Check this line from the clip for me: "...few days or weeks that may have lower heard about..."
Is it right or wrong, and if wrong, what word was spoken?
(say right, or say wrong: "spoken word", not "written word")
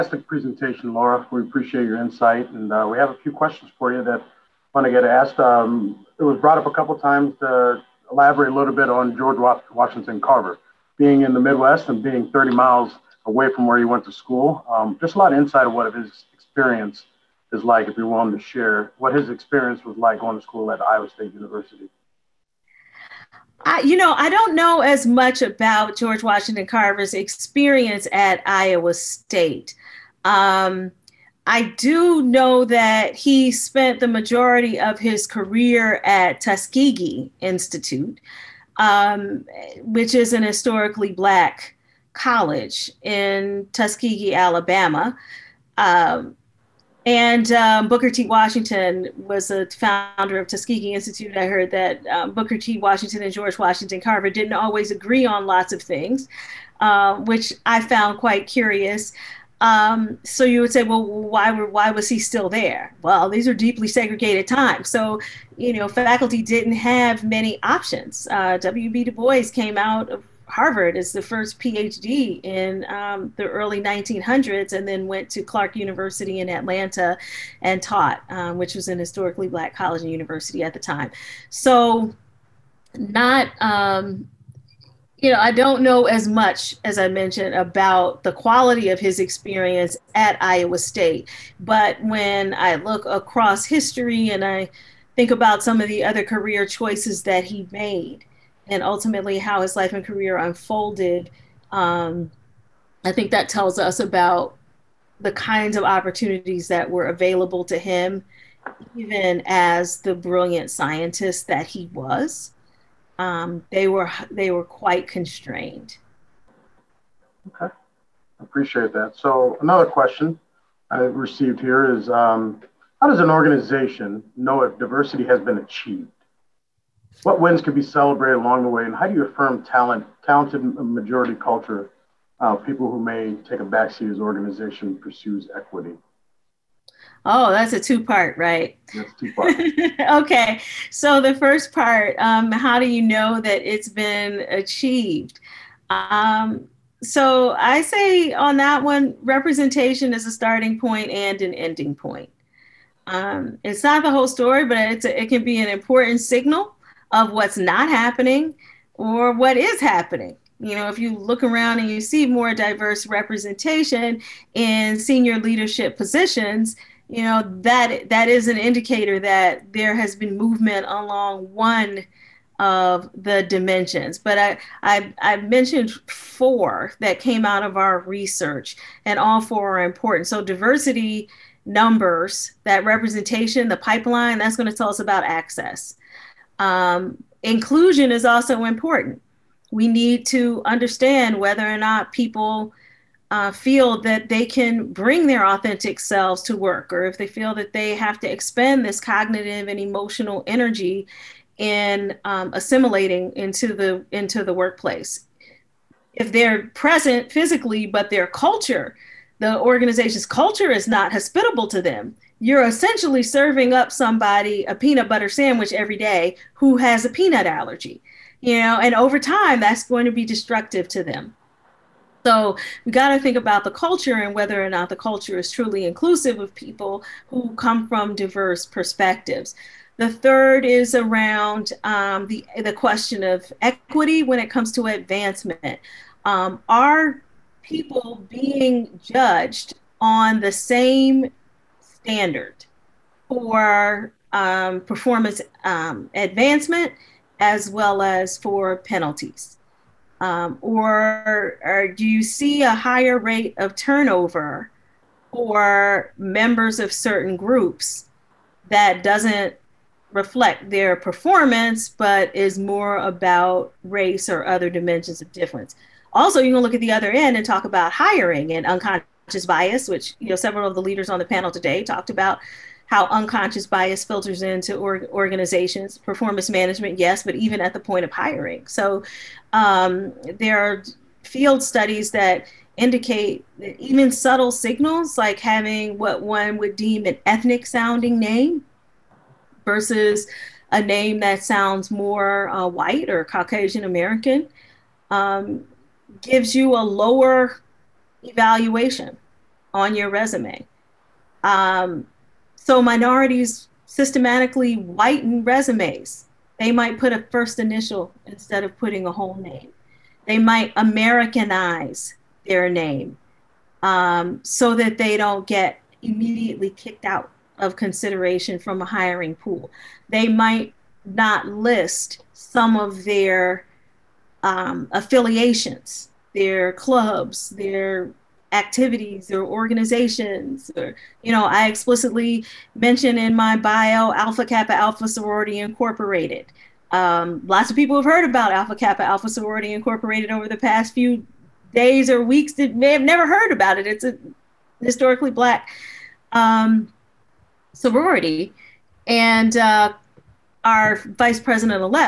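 wrong: "never", not "lower".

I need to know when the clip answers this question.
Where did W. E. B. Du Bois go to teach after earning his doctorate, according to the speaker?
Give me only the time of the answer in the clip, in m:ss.
1:15.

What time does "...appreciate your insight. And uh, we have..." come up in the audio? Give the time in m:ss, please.
0:01.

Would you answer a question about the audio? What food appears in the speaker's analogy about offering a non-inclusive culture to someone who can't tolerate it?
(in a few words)
peanut butter sandwich.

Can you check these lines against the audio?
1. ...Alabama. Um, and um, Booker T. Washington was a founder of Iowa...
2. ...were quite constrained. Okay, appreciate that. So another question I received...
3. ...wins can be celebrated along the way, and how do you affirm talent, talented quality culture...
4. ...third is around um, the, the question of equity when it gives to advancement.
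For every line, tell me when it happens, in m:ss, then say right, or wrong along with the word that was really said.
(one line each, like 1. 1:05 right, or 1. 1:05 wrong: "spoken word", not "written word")
1. 0:44 wrong: "Tuskegee", not "Iowa"
2. 1:54 right
3. 2:07 wrong: "majority", not "quality"
4. 3:50 wrong: "comes", not "gives".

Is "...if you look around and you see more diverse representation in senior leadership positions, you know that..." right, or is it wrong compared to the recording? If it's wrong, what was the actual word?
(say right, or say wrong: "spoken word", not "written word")
right.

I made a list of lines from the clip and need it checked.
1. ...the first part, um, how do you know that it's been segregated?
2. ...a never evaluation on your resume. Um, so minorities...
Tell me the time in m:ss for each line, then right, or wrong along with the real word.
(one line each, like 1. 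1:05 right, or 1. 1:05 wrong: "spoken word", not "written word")
1. 2:21 wrong: "achieved", not "segregated"
2. 4:56 wrong: "lower", not "never".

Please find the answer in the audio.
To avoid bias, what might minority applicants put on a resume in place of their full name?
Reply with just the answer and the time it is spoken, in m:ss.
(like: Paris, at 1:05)
first initial, at 5:07.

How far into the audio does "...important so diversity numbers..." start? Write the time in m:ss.
2:59.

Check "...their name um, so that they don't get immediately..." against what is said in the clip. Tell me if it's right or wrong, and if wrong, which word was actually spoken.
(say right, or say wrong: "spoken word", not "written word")
right.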